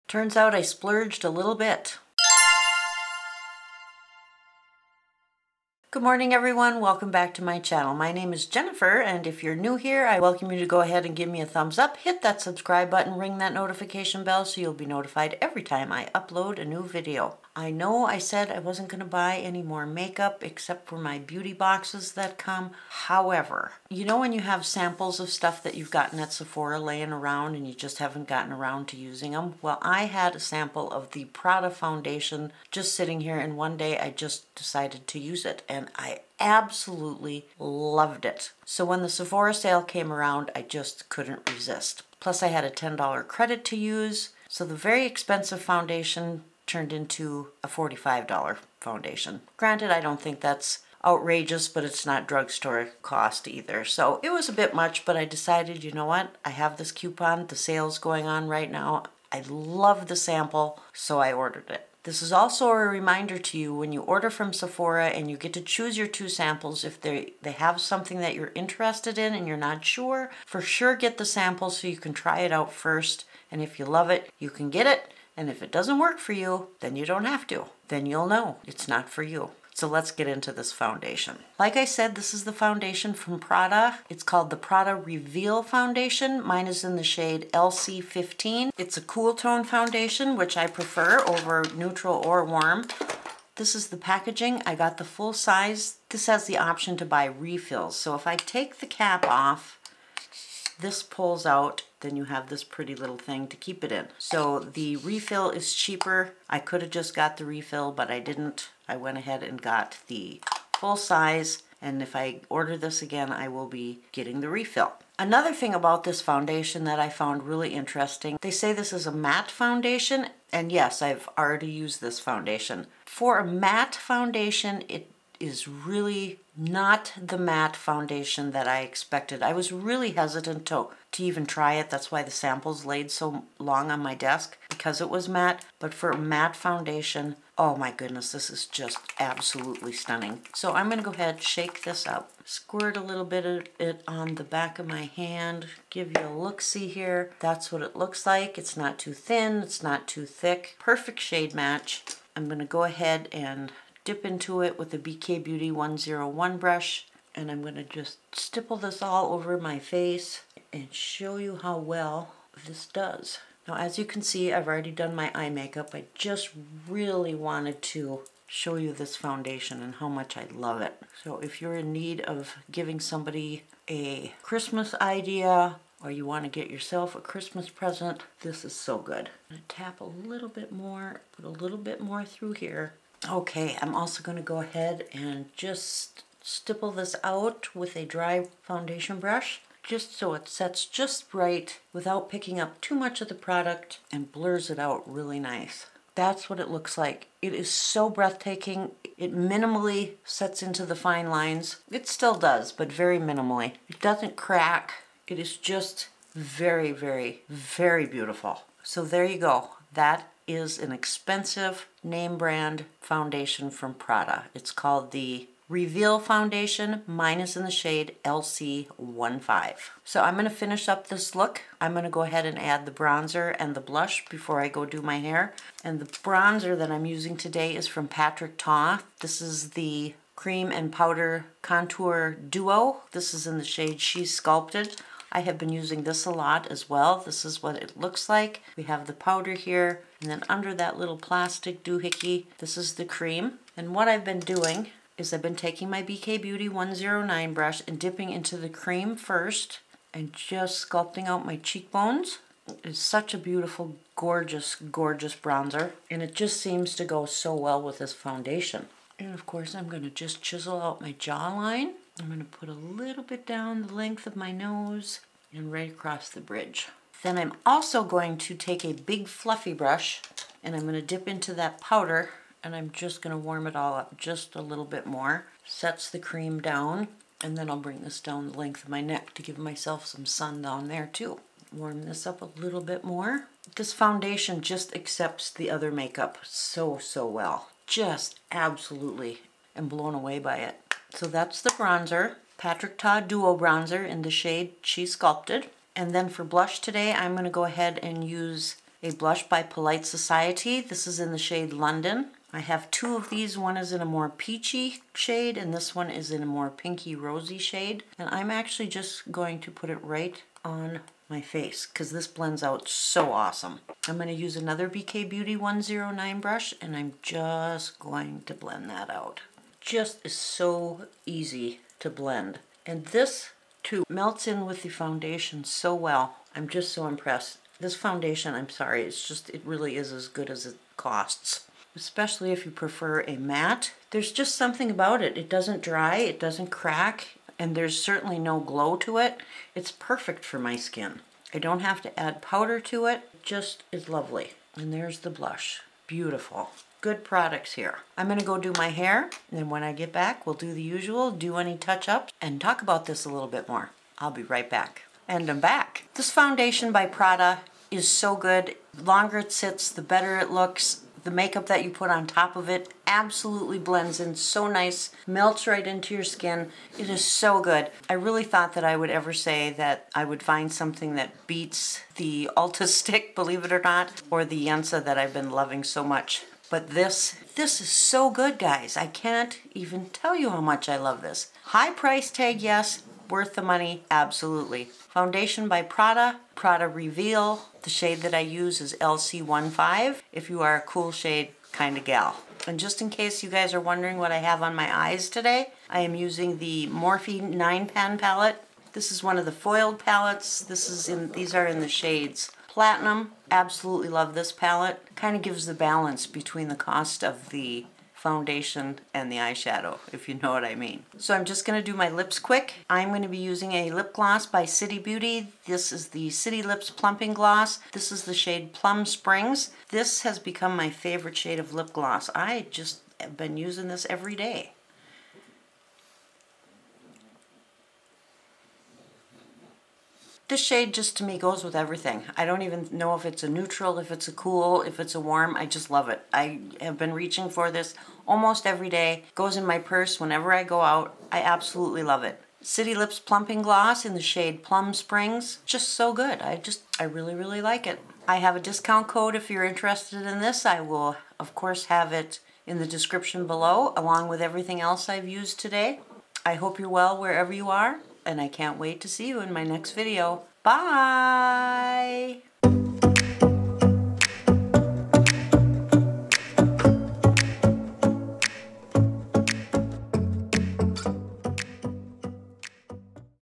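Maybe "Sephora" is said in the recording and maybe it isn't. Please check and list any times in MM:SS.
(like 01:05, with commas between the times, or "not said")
00:26, 00:39, 01:04.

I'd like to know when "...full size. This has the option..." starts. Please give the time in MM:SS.
01:35.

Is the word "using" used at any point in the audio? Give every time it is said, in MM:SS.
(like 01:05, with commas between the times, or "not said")
00:28, 03:47, 03:55, 06:36, 06:53, 07:03.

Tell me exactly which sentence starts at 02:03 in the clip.
For a matte foundation, it is really not the matte foundation that I expected.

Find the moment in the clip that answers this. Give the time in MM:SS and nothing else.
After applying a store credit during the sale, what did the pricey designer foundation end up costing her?
00:47.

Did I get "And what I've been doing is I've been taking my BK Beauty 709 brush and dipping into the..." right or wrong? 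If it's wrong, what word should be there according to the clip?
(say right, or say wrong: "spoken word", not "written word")
wrong: "109", not "709".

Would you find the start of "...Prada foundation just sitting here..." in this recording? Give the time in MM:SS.
00:31.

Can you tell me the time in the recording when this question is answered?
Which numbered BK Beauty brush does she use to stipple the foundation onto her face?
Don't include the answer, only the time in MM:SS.
02:34.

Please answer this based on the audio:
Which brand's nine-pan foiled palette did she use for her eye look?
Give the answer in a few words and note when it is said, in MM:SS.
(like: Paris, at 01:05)
Morphe, at 06:36.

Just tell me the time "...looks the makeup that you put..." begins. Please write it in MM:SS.
06:00.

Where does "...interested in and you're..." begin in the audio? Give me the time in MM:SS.
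01:08.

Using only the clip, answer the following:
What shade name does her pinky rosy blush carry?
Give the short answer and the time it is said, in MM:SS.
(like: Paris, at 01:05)
London, at 05:01.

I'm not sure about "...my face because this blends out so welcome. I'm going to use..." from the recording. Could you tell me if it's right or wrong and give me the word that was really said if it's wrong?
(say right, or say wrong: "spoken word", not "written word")
wrong: "awesome", not "welcome".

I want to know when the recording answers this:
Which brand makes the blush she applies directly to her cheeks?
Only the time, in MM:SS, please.
04:59.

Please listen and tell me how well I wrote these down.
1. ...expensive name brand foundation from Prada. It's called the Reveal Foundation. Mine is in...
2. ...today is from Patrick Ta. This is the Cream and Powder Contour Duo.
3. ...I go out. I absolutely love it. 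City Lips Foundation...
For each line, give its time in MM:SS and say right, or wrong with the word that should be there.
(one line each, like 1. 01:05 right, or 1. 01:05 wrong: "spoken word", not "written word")
1. 03:30 right
2. 03:47 right
3. 07:20 wrong: "Plumping", not "Foundation".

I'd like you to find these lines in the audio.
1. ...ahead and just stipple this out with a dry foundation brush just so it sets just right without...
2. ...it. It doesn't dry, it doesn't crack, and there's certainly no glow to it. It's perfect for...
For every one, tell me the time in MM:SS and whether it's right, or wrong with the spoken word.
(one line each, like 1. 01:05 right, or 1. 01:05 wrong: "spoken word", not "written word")
1. 03:04 right
2. 05:35 right.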